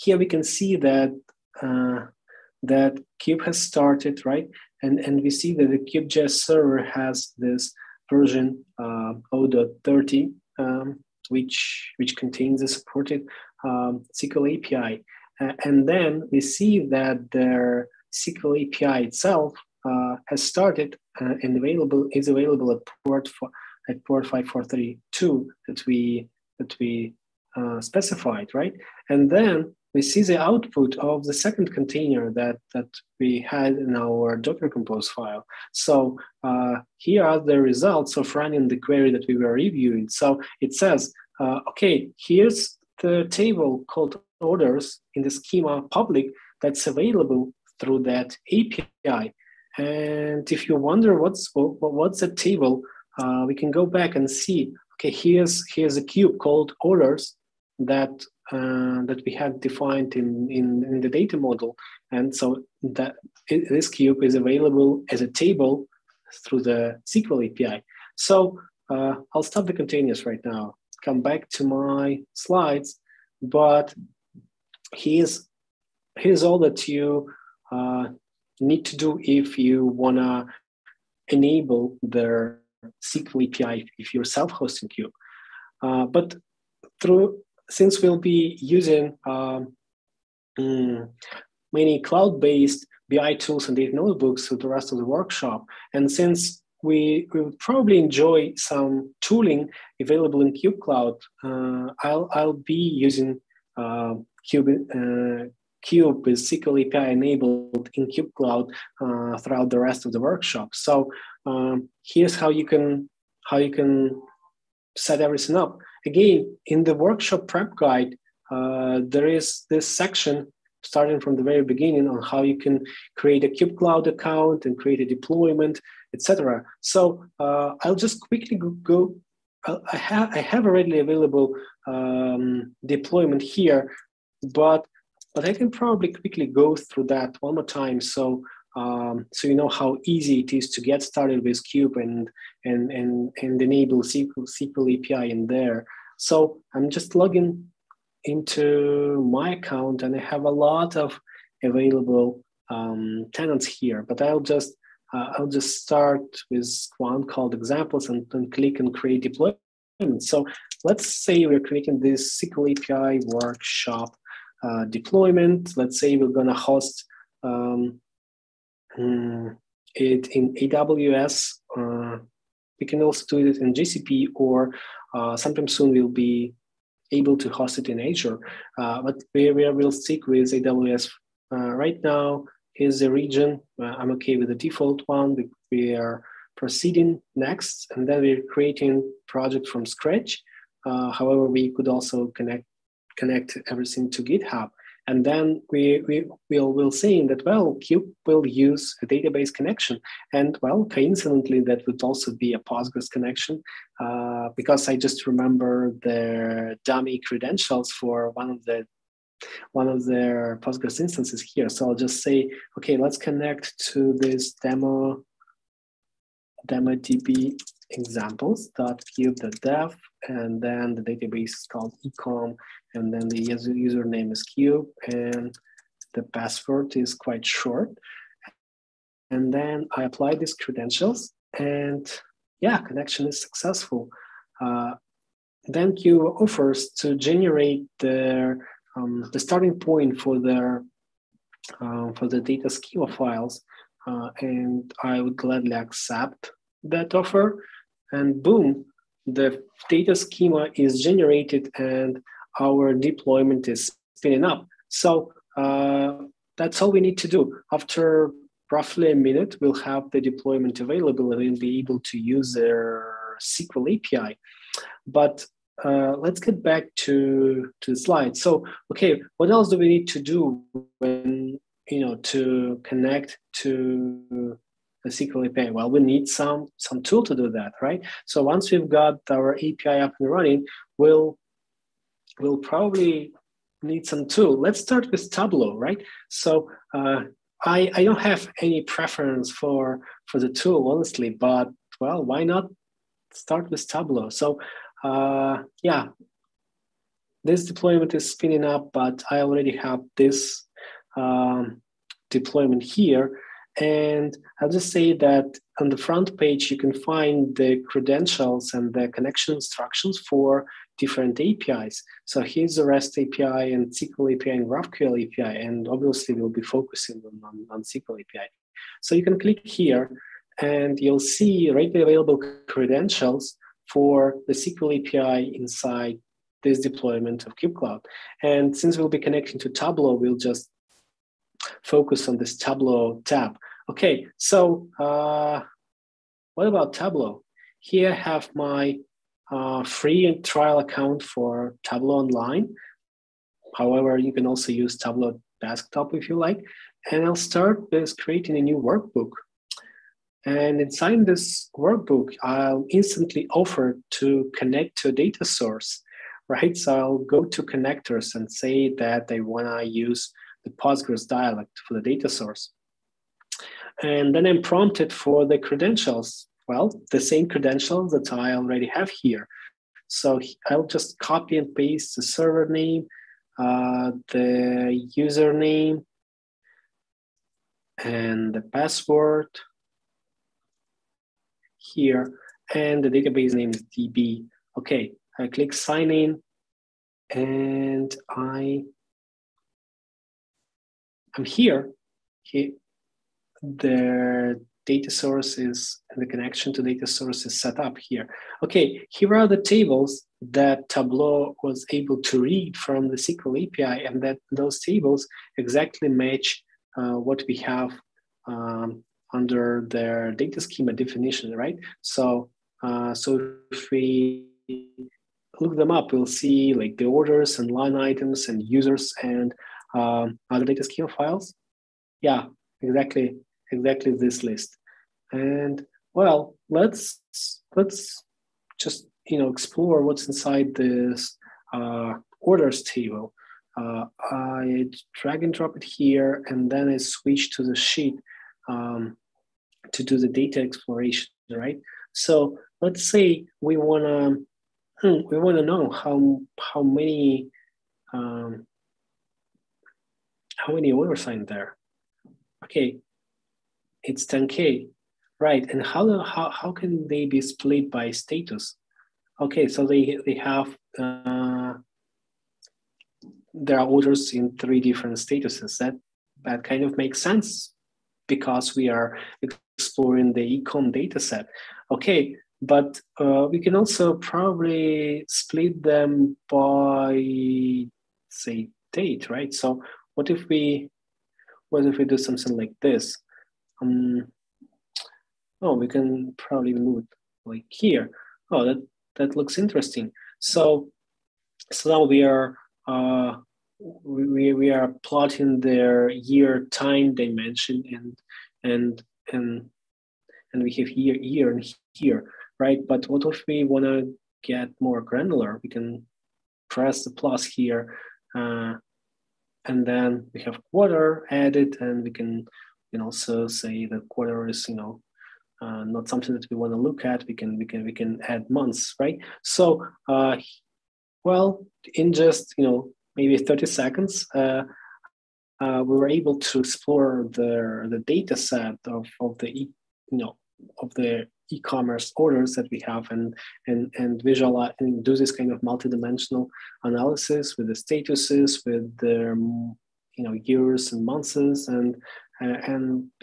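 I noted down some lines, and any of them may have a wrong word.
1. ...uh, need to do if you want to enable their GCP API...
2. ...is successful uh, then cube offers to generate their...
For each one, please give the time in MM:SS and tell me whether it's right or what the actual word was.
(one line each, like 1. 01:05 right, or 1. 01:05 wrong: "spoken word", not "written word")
1. 01:17 wrong: "SQL", not "GCP"
2. 03:53 right.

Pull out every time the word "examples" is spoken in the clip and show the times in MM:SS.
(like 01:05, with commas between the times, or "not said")
02:37, 03:37.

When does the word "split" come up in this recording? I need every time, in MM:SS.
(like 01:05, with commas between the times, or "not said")
07:37, 07:55.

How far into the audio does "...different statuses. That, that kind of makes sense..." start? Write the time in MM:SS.
07:44.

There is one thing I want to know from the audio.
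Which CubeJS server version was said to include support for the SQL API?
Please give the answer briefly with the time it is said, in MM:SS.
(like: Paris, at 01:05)
0.30, at 00:09.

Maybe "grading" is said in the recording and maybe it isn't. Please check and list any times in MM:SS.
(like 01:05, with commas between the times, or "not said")
not said.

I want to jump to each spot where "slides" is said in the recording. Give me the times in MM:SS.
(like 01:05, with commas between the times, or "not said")
01:12, 04:27.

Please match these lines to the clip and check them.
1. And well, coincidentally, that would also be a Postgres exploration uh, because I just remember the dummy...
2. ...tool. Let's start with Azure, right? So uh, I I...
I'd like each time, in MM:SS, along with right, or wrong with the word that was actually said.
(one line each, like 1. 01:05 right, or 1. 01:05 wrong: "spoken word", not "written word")
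1. 03:20 wrong: "connection", not "exploration"
2. 04:44 wrong: "Tableau", not "Azure".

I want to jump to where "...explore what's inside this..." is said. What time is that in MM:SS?
07:09.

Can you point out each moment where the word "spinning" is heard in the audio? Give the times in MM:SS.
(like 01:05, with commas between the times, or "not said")
04:14, 04:58.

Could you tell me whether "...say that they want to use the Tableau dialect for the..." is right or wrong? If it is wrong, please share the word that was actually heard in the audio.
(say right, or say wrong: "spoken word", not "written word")
wrong: "Postgres", not "Tableau".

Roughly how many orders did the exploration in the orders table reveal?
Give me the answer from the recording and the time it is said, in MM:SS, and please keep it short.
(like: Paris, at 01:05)
10K, at 07:34.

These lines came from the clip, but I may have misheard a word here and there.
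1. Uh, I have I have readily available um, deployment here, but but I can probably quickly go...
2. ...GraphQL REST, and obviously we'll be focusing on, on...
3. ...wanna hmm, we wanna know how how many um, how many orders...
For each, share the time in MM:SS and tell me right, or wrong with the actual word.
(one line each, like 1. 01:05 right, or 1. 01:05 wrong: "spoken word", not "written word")
1. 02:09 right
2. 05:14 wrong: "API", not "REST"
3. 07:23 right.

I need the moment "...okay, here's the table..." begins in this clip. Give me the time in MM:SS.
00:41.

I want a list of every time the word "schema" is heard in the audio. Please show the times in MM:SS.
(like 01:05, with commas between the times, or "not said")
00:45, 04:02, 04:10, 06:50, 07:00.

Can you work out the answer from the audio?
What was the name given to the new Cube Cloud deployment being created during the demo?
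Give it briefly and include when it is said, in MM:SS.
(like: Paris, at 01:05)
SQL API workshop, at 02:42.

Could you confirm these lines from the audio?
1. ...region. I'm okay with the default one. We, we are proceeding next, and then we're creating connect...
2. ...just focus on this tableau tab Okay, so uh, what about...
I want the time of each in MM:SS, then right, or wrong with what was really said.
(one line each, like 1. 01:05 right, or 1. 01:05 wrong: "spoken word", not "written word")
1. 03:03 wrong: "project", not "connect"
2. 05:30 right.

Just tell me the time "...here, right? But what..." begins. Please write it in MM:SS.
08:21.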